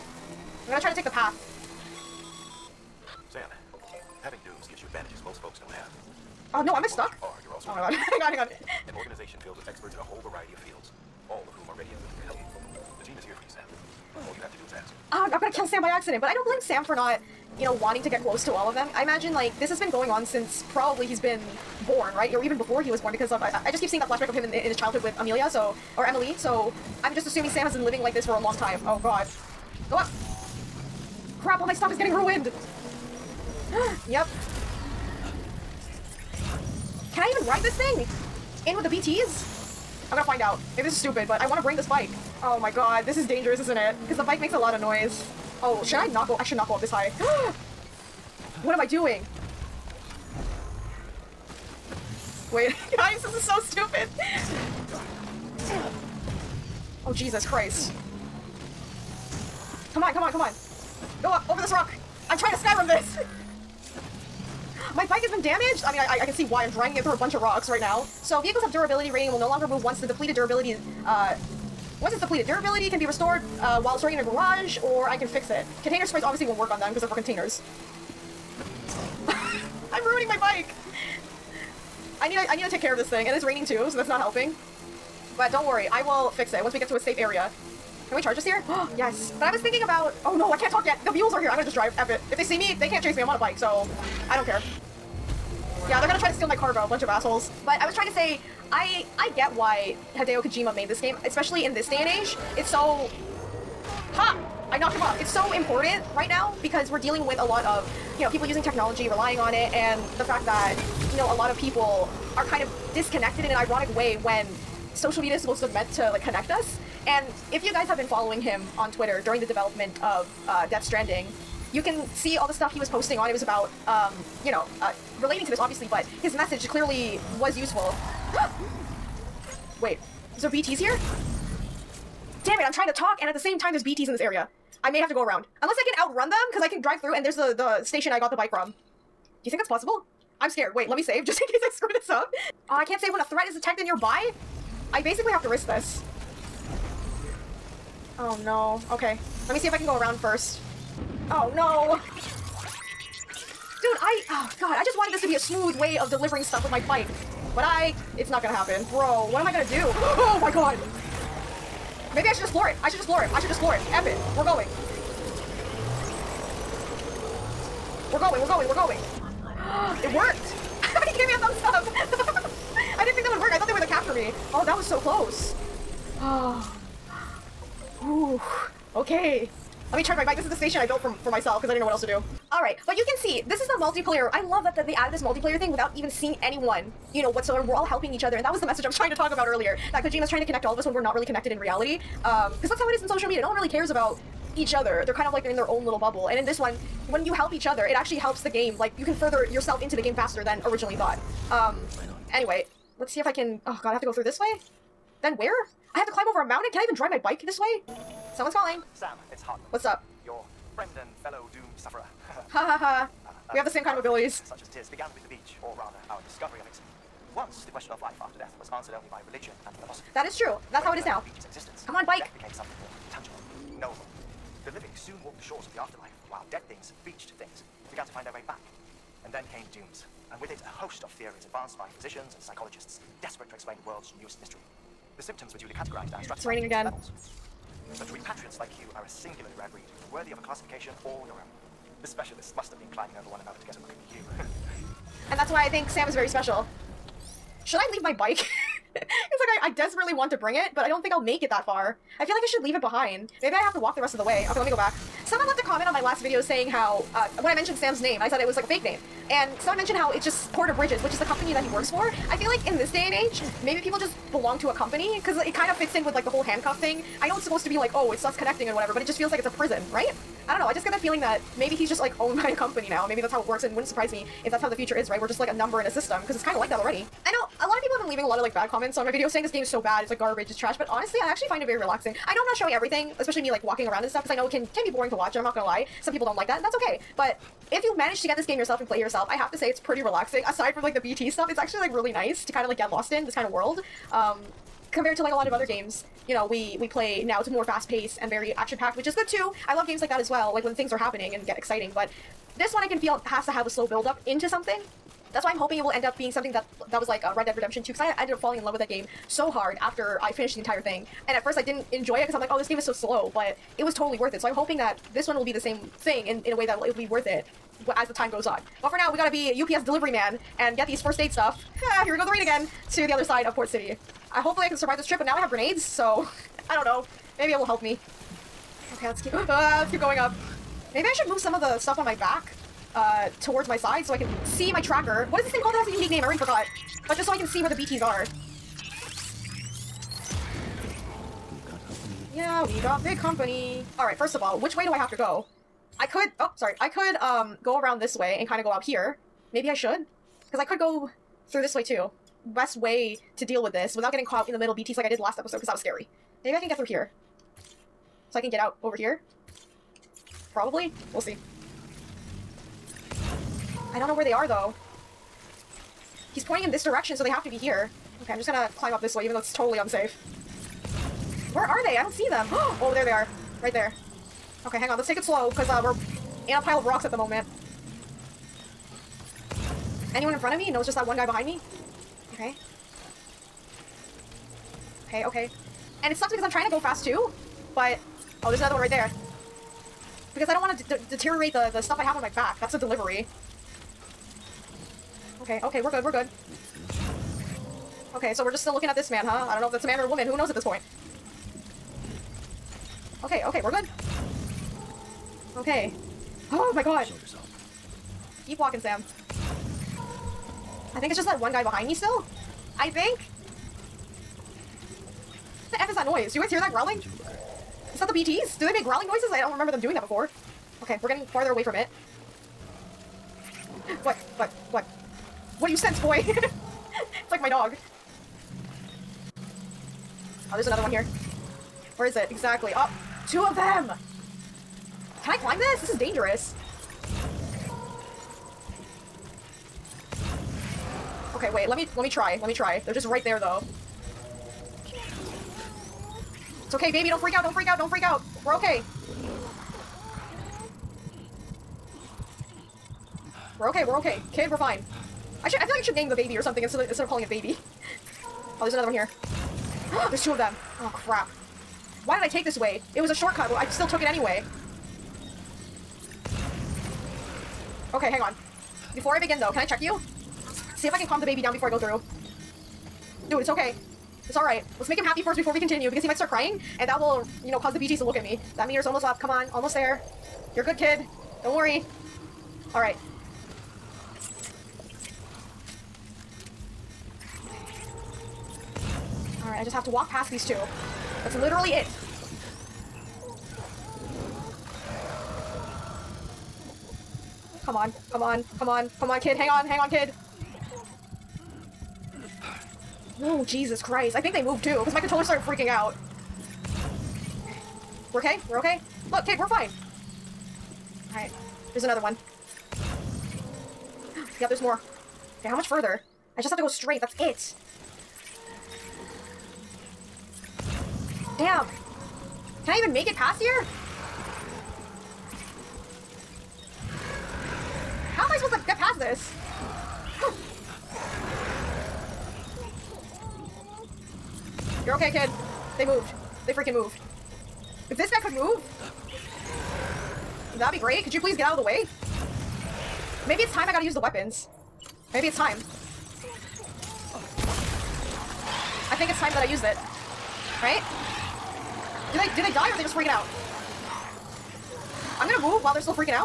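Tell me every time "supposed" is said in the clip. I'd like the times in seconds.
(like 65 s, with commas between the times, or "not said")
115 s, 267 s, 528 s.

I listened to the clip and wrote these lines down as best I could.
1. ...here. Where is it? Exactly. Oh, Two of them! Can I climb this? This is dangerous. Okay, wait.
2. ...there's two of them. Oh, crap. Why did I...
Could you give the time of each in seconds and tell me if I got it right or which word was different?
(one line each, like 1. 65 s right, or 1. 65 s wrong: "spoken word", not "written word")
1. 430 s right
2. 460 s right.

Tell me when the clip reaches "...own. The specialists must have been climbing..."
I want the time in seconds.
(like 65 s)
241 s.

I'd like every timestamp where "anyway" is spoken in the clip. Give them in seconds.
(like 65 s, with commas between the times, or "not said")
202 s, 464 s.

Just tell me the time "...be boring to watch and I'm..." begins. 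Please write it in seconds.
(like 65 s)
284 s.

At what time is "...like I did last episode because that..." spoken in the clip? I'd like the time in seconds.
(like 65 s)
354 s.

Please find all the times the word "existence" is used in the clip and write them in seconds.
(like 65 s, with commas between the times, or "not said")
221 s.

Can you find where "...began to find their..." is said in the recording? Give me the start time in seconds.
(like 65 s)
227 s.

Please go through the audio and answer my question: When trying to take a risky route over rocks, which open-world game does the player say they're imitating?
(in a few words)
Skyrim.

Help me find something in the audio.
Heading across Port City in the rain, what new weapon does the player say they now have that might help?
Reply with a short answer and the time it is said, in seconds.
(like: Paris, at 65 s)
grenades, at 325 s.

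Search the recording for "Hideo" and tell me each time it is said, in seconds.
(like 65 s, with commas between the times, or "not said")
100 s.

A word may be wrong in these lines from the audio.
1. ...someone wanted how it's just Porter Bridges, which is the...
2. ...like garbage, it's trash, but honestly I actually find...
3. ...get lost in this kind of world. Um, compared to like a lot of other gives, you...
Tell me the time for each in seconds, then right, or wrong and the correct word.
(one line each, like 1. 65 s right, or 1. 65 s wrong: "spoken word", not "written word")
1. 259 s wrong: "mentioned", not "wanted"
2. 280 s right
3. 292 s wrong: "games", not "gives".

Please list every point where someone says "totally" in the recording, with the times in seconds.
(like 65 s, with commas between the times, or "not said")
313 s, 369 s.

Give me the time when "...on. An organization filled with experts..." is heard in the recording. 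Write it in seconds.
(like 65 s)
8 s.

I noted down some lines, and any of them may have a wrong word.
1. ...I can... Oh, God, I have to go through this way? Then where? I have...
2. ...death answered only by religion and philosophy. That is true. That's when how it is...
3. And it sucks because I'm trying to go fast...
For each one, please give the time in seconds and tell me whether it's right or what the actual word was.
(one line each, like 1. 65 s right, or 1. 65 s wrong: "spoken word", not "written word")
1. 203 s right
2. 218 s right
3. 386 s right.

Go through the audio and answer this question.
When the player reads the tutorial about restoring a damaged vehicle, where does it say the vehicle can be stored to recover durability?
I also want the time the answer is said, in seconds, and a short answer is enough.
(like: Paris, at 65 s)
garage, at 74 s.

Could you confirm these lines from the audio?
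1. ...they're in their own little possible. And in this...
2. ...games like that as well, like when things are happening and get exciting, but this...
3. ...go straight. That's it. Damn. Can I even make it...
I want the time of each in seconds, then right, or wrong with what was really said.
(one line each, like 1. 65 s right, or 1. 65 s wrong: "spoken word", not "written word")
1. 195 s wrong: "bubble", not "possible"
2. 299 s right
3. 516 s right.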